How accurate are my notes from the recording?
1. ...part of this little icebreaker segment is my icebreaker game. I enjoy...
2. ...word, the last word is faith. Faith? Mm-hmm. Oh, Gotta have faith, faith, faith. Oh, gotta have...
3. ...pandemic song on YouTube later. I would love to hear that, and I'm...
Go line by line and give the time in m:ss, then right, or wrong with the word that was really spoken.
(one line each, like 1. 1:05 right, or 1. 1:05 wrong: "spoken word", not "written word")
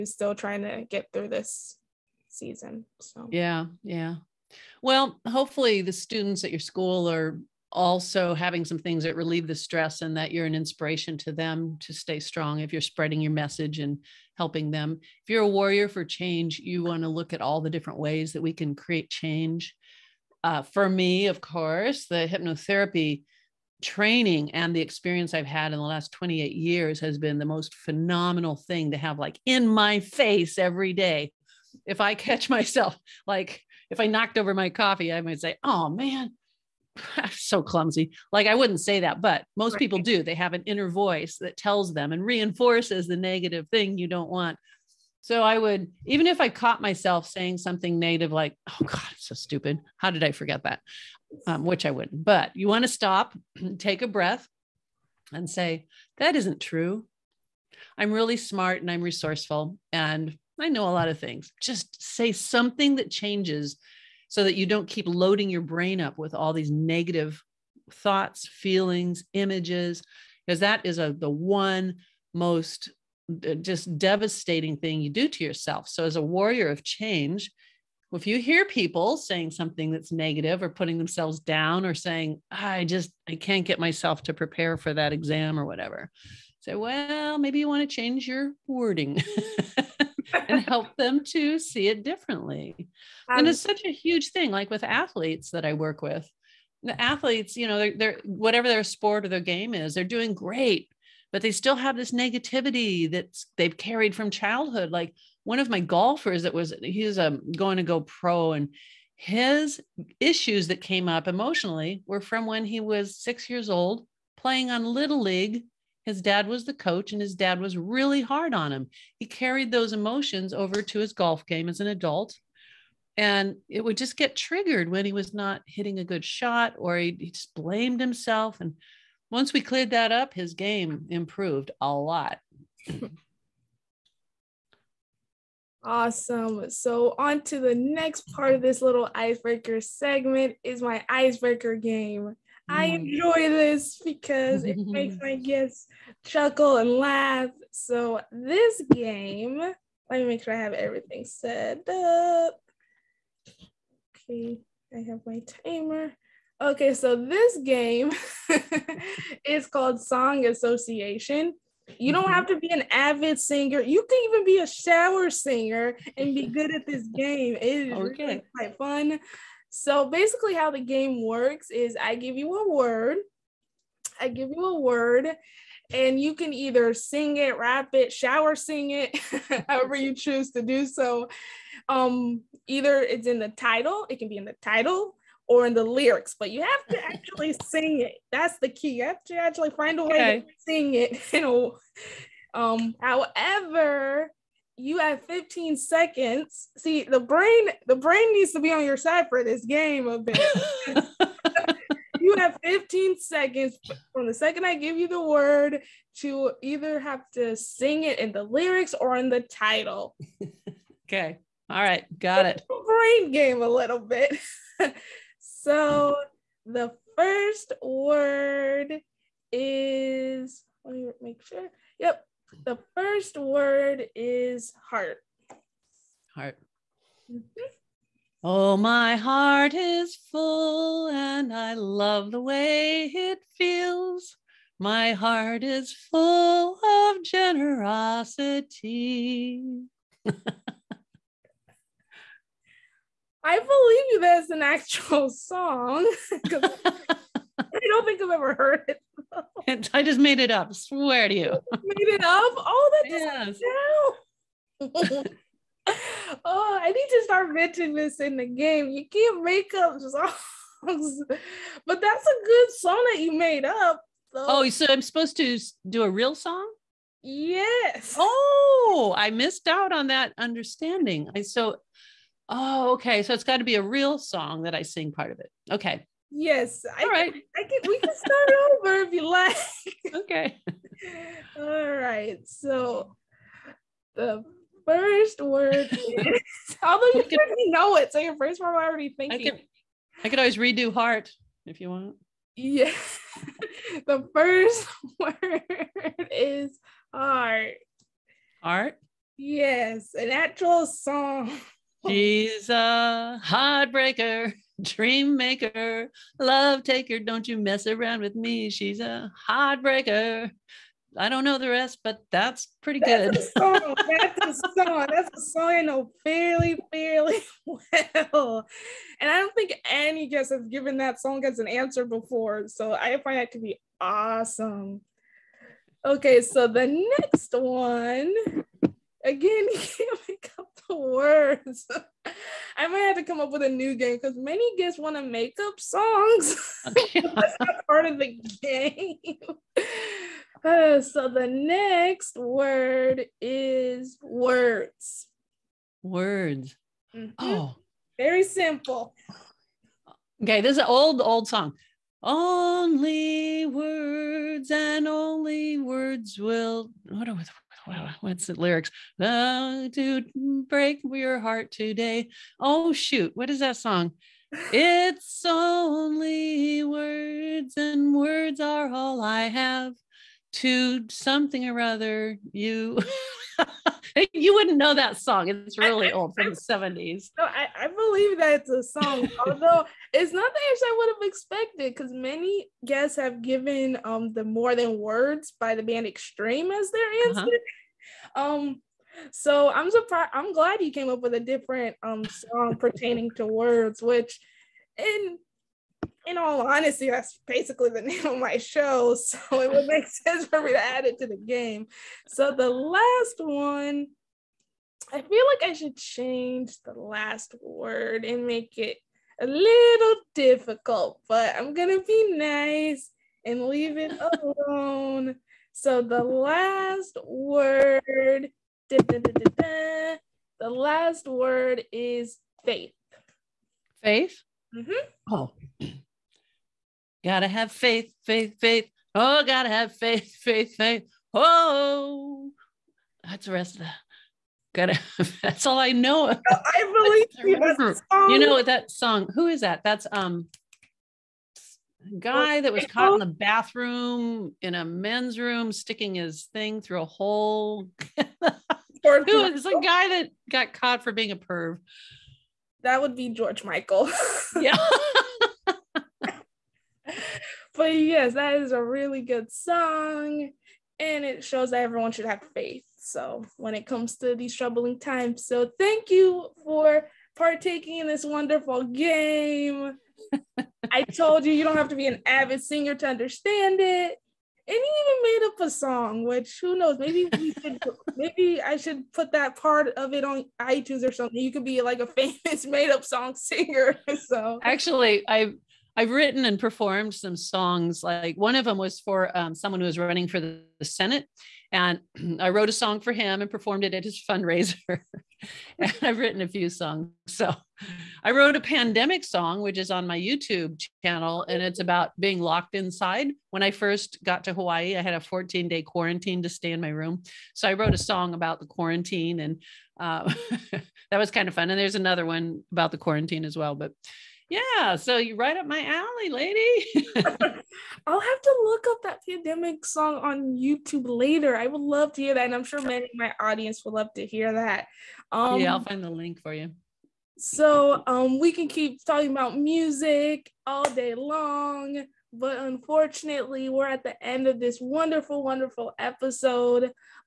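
1. 2:18 right
2. 6:57 right
3. 8:39 right.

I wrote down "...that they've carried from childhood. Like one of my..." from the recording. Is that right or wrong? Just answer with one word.
right.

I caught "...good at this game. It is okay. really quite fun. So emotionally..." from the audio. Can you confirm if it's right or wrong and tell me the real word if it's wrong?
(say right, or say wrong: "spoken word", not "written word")
wrong: "basically", not "emotionally".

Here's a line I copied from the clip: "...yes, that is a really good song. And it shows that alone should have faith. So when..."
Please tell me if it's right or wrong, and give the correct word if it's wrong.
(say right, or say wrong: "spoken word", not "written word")
wrong: "everyone", not "alone".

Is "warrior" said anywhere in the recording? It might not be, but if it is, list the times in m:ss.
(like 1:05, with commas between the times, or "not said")
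0:15, 1:16.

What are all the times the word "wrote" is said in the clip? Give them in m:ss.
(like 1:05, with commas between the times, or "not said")
8:12, 8:18, 8:27.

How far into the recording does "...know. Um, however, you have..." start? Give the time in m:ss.
3:11.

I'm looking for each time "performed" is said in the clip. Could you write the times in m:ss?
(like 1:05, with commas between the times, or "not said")
8:06, 8:13.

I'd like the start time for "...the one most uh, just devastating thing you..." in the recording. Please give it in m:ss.
1:11.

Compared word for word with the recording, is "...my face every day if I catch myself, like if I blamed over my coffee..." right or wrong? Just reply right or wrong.
wrong.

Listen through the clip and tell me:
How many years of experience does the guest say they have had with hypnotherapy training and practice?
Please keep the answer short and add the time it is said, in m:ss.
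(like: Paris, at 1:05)
28, at 0:26.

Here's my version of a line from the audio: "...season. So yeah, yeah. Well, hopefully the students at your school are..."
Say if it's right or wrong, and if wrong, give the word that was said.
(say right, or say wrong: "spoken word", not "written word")
right.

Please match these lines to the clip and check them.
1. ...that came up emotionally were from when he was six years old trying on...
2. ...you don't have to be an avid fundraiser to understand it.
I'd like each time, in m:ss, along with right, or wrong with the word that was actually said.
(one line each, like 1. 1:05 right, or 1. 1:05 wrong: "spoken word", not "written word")
1. 1:50 wrong: "playing", not "trying"
2. 7:51 wrong: "singer", not "fundraiser".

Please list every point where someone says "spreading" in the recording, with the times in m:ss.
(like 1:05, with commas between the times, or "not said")
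0:12.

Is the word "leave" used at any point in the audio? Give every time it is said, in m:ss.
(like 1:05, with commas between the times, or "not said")
6:53.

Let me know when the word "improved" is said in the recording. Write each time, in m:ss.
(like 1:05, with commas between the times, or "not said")
2:11.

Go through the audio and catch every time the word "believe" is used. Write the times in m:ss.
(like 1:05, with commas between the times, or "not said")
4:03, 6:17, 7:17.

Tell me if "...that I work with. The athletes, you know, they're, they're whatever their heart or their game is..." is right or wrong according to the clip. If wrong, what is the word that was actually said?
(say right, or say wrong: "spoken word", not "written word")
wrong: "sport", not "heart".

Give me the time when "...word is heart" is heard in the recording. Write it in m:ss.
3:43.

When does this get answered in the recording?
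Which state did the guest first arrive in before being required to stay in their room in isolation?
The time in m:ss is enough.
8:24.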